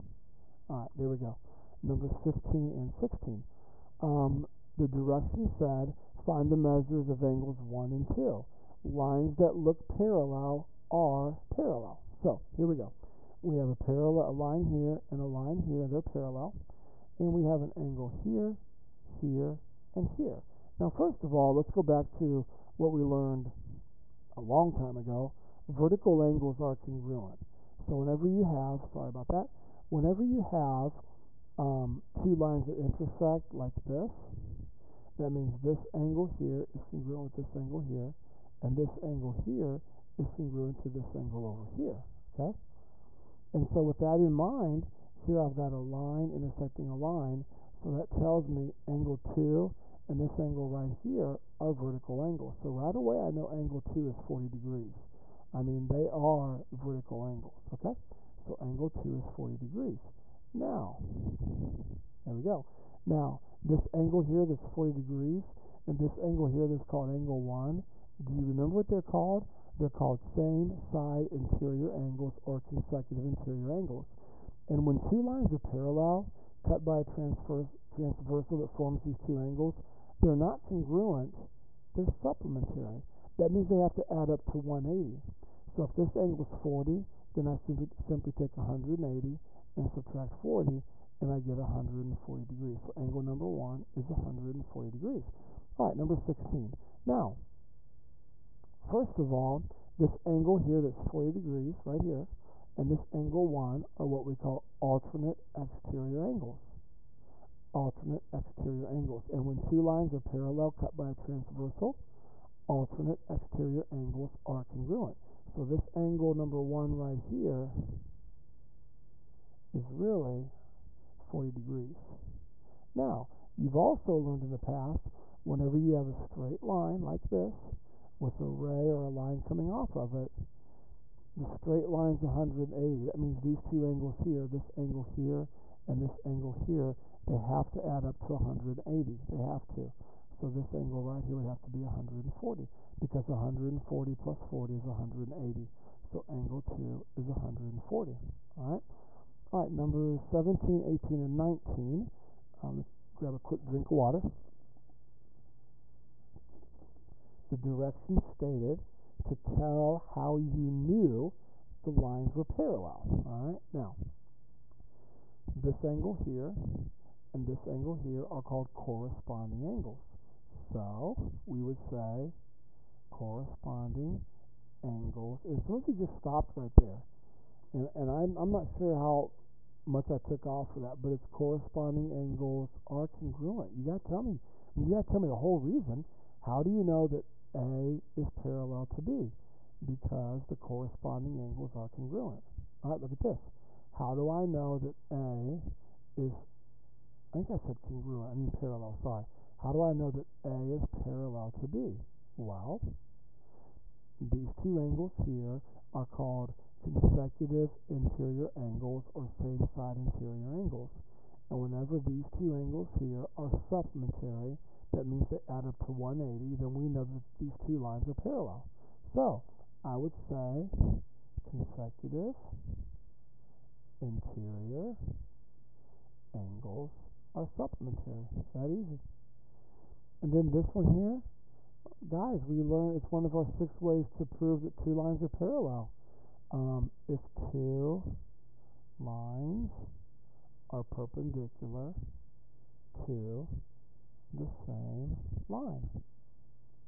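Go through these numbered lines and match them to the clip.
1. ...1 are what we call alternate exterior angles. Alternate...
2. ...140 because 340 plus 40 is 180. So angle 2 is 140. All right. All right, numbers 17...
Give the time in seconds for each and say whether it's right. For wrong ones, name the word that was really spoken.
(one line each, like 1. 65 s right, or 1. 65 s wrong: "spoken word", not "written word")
1. 103 s right
2. 141 s wrong: "140", not "340".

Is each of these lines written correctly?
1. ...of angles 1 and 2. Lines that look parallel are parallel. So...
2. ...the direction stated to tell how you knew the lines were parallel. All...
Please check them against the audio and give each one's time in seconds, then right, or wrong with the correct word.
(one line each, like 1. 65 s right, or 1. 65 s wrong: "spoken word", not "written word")
1. 7 s right
2. 157 s right.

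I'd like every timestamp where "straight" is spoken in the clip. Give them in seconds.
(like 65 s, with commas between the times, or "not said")
126 s, 131 s.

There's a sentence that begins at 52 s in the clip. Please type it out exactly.
So right away I know angle 2 is 40 degrees.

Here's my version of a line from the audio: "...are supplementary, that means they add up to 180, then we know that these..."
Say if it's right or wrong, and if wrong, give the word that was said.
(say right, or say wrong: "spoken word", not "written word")
right.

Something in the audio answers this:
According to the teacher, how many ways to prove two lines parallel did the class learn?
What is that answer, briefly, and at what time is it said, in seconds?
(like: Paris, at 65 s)
6, at 233 s.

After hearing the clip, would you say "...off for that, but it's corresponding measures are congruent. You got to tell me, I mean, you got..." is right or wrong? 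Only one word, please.
wrong.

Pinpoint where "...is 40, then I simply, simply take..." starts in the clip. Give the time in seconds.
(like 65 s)
86 s.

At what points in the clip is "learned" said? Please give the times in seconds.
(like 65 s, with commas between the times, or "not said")
23 s, 124 s, 232 s.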